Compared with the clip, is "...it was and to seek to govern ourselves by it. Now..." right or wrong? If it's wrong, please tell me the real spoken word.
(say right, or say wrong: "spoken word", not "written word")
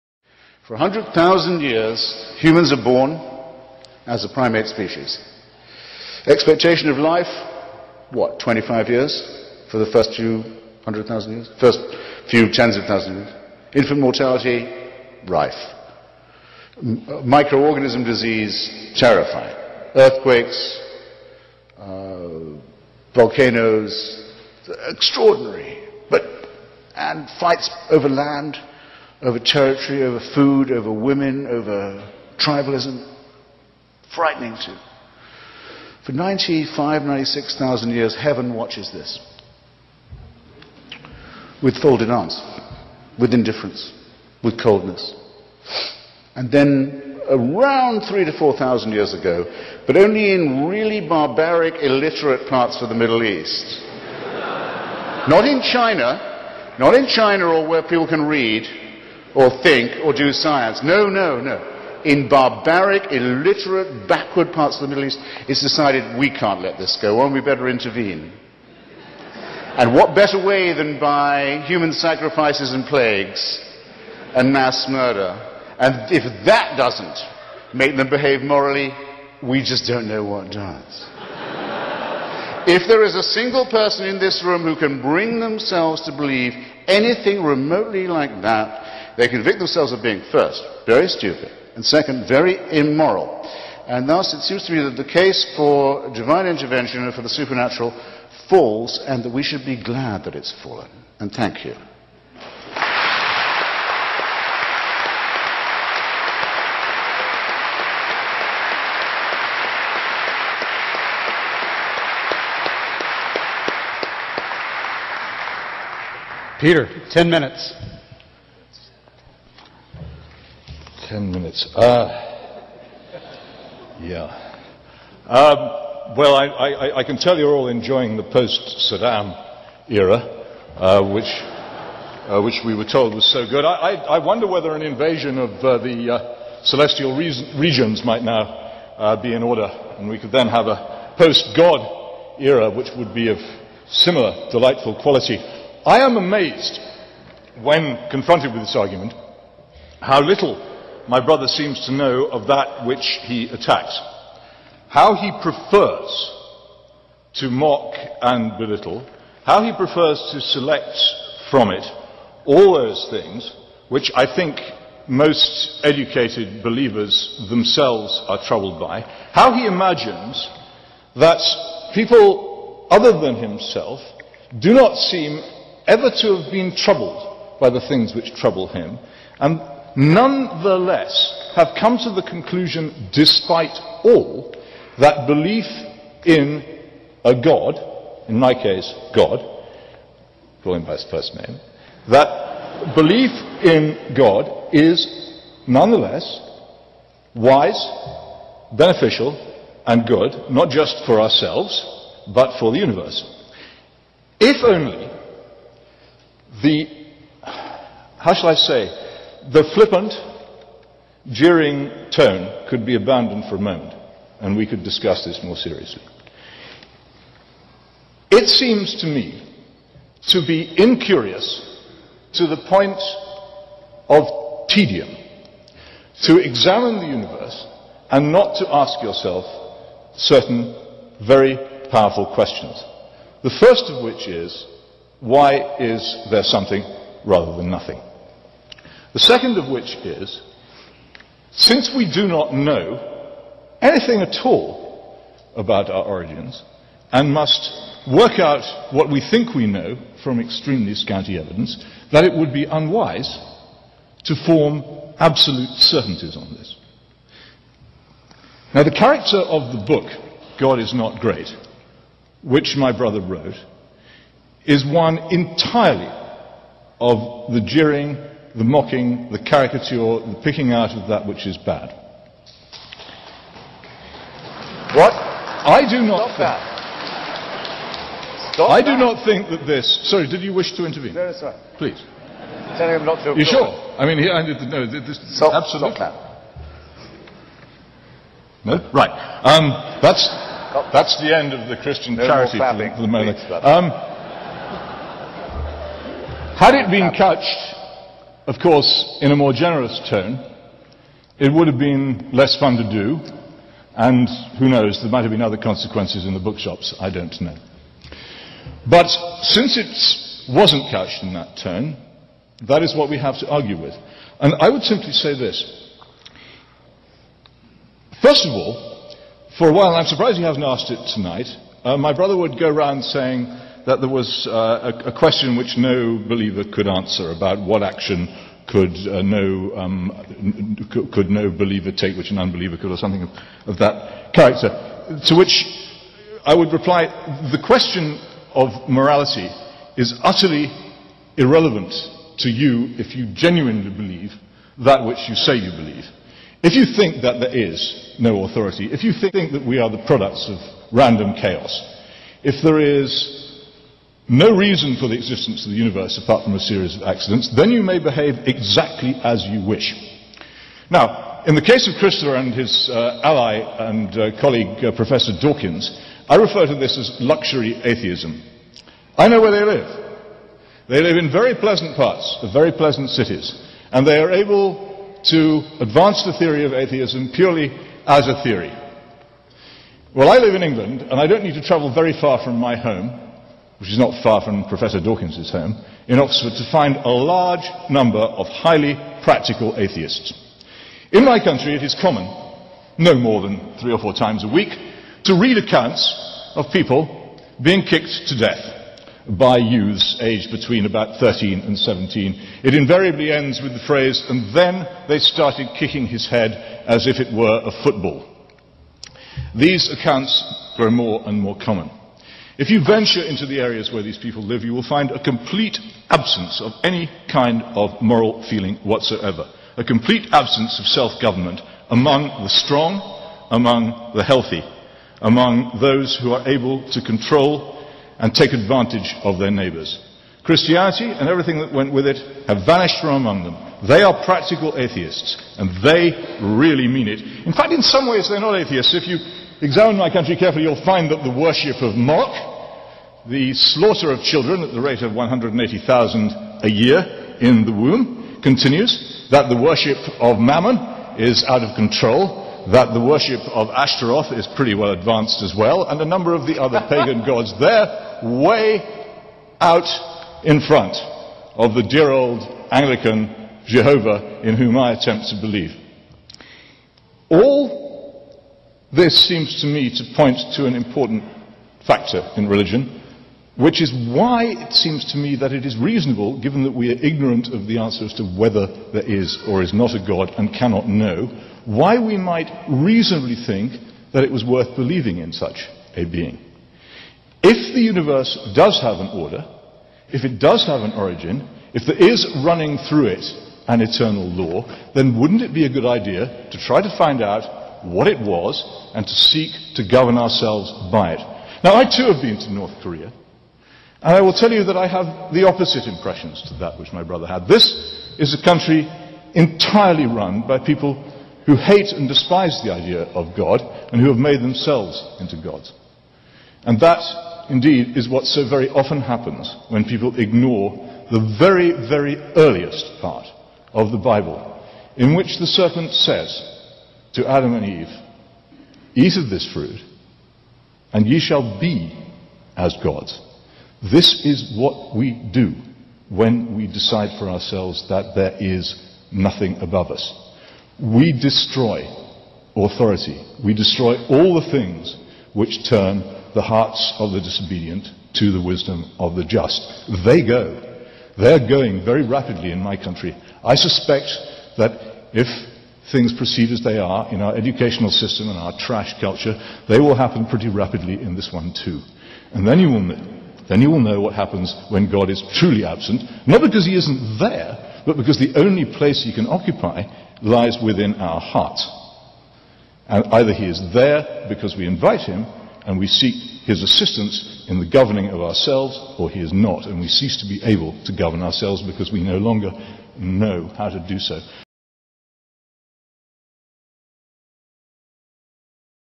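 right.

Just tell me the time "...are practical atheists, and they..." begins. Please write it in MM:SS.
07:14.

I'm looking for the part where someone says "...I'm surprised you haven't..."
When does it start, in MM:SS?
05:19.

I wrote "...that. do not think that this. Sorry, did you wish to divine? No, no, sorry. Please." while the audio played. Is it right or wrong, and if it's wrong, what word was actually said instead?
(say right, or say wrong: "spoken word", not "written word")
wrong: "intervene", not "divine".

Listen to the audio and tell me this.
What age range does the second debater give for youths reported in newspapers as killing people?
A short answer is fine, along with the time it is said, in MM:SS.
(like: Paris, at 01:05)
13 to 17, at 06:41.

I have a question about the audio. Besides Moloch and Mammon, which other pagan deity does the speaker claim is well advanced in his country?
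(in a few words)
Ashtaroth.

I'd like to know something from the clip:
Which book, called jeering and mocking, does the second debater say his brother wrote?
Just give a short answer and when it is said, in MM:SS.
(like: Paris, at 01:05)
God is Not Great, at 04:20.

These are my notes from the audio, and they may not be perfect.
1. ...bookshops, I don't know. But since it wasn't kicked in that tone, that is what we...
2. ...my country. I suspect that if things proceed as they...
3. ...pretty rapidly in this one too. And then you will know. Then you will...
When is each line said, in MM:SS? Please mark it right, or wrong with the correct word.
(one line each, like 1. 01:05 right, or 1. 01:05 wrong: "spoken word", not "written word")
1. 05:06 wrong: "couched", not "kicked"
2. 09:12 right
3. 09:20 right.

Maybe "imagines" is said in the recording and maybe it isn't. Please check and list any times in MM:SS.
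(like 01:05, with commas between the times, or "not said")
02:49.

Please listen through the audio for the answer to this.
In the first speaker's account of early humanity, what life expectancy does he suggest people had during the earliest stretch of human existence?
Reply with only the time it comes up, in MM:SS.
00:08.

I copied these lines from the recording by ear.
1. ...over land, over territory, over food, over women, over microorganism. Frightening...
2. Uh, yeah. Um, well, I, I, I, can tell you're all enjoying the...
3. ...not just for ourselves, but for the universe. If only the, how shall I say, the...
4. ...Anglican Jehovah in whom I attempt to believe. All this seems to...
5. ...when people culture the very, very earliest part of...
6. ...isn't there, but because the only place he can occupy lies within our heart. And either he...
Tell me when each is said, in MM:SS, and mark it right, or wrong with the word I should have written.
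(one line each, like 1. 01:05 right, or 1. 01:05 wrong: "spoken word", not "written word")
1. 00:27 wrong: "tribalism", not "microorganism"
2. 02:01 right
3. 03:20 right
4. 07:42 right
5. 08:39 wrong: "ignore", not "culture"
6. 09:26 right.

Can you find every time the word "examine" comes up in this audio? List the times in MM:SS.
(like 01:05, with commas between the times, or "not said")
03:46, 07:19.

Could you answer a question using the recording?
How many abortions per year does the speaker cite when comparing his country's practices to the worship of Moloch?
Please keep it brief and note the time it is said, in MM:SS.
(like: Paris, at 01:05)
180,000, at 07:25.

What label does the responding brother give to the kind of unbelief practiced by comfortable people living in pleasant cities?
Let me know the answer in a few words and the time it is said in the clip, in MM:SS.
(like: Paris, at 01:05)
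luxury atheism, at 06:07.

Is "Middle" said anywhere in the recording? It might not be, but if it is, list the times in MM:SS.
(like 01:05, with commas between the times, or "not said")
00:52, 01:04.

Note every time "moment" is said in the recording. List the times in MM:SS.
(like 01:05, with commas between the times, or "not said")
03:33, 04:53.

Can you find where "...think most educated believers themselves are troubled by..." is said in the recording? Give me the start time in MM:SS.
02:44.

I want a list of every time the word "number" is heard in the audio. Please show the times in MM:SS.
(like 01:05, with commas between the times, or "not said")
06:27, 07:36.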